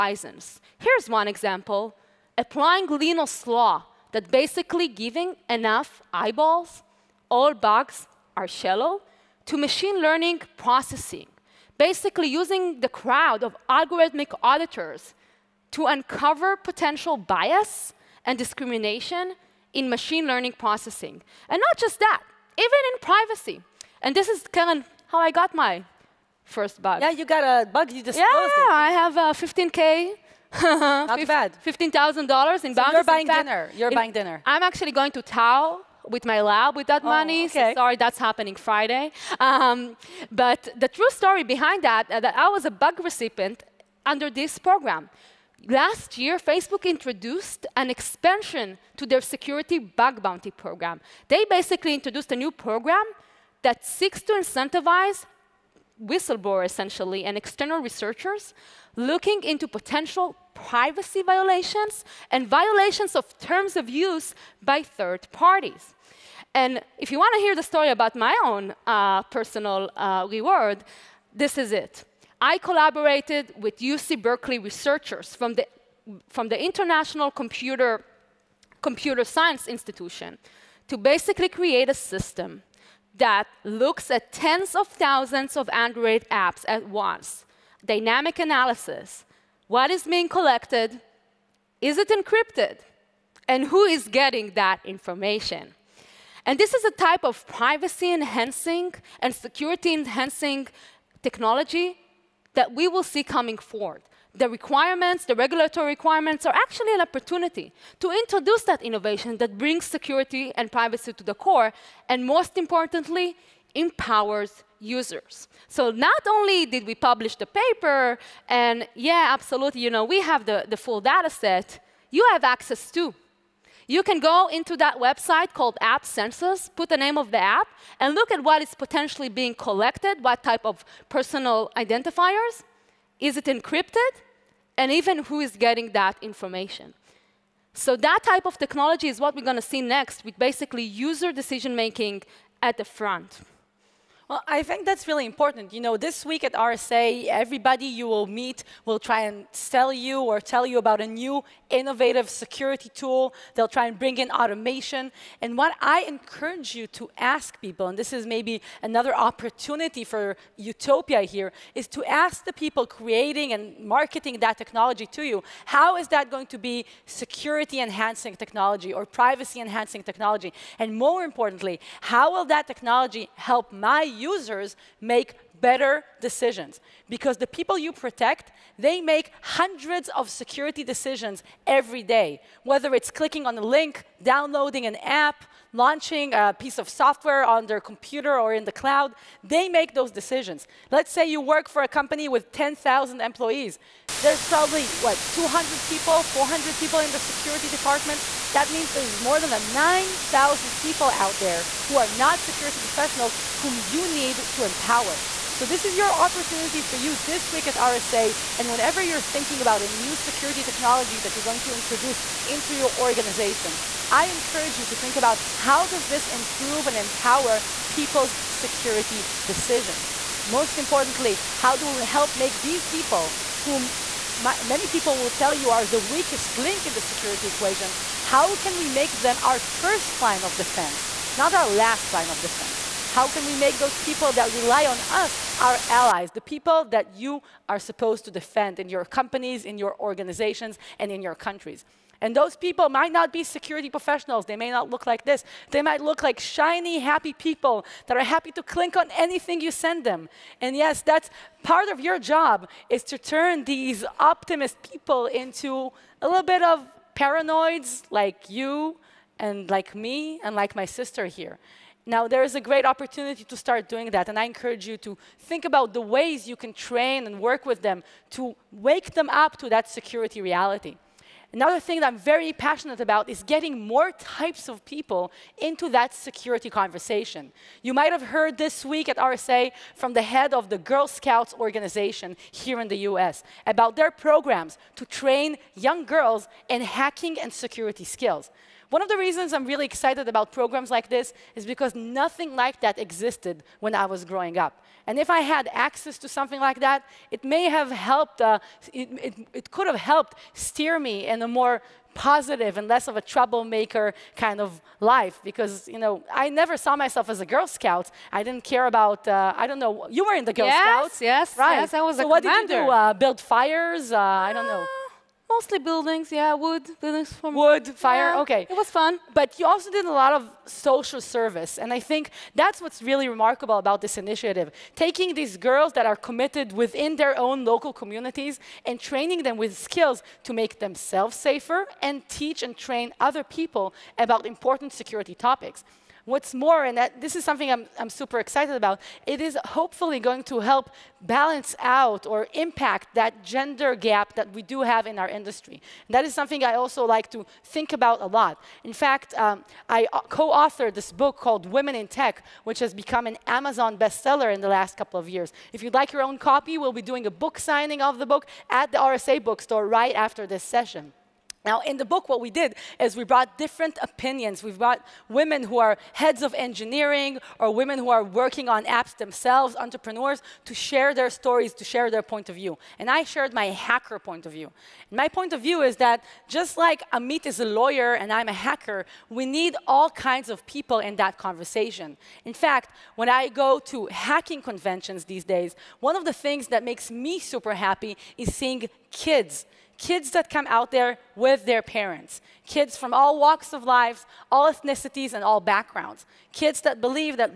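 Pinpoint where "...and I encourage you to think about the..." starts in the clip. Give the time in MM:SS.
04:24.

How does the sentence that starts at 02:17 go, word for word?
So that type of technology is what we're going to see next with basically user decision making at the front.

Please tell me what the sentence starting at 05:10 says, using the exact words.
You were in the Girl yes, Scouts, yes, right?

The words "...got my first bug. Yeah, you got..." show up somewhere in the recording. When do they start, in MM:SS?
00:25.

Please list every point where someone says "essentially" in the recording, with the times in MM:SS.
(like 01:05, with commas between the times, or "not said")
00:56.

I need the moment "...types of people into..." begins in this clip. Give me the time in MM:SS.
04:34.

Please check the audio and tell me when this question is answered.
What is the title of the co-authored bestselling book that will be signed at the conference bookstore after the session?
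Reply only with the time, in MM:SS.
05:51.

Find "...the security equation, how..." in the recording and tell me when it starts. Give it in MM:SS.
03:46.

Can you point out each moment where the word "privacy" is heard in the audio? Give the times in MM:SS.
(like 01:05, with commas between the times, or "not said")
00:22, 01:00, 01:37, 01:50, 02:49.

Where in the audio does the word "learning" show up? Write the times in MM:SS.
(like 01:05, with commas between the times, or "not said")
00:09, 00:20.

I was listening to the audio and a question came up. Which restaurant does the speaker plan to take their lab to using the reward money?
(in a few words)
Tao.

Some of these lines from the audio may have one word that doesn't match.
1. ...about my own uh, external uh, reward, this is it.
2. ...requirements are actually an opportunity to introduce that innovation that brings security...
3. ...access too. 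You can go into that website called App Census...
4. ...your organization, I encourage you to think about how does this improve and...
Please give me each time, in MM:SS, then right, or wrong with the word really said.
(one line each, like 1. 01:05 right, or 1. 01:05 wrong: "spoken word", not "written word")
1. 01:07 wrong: "personal", not "external"
2. 01:45 right
3. 02:02 right
4. 03:32 right.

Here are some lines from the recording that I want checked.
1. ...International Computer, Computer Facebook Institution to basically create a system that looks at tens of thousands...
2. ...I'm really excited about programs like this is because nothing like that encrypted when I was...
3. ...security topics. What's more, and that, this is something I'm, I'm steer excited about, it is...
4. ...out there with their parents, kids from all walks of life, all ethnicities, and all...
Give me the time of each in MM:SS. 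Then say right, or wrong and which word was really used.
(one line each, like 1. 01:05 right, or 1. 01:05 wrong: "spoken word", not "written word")
1. 01:16 wrong: "Science", not "Facebook"
2. 04:49 wrong: "existed", not "encrypted"
3. 05:35 wrong: "super", not "steer"
4. 06:30 right.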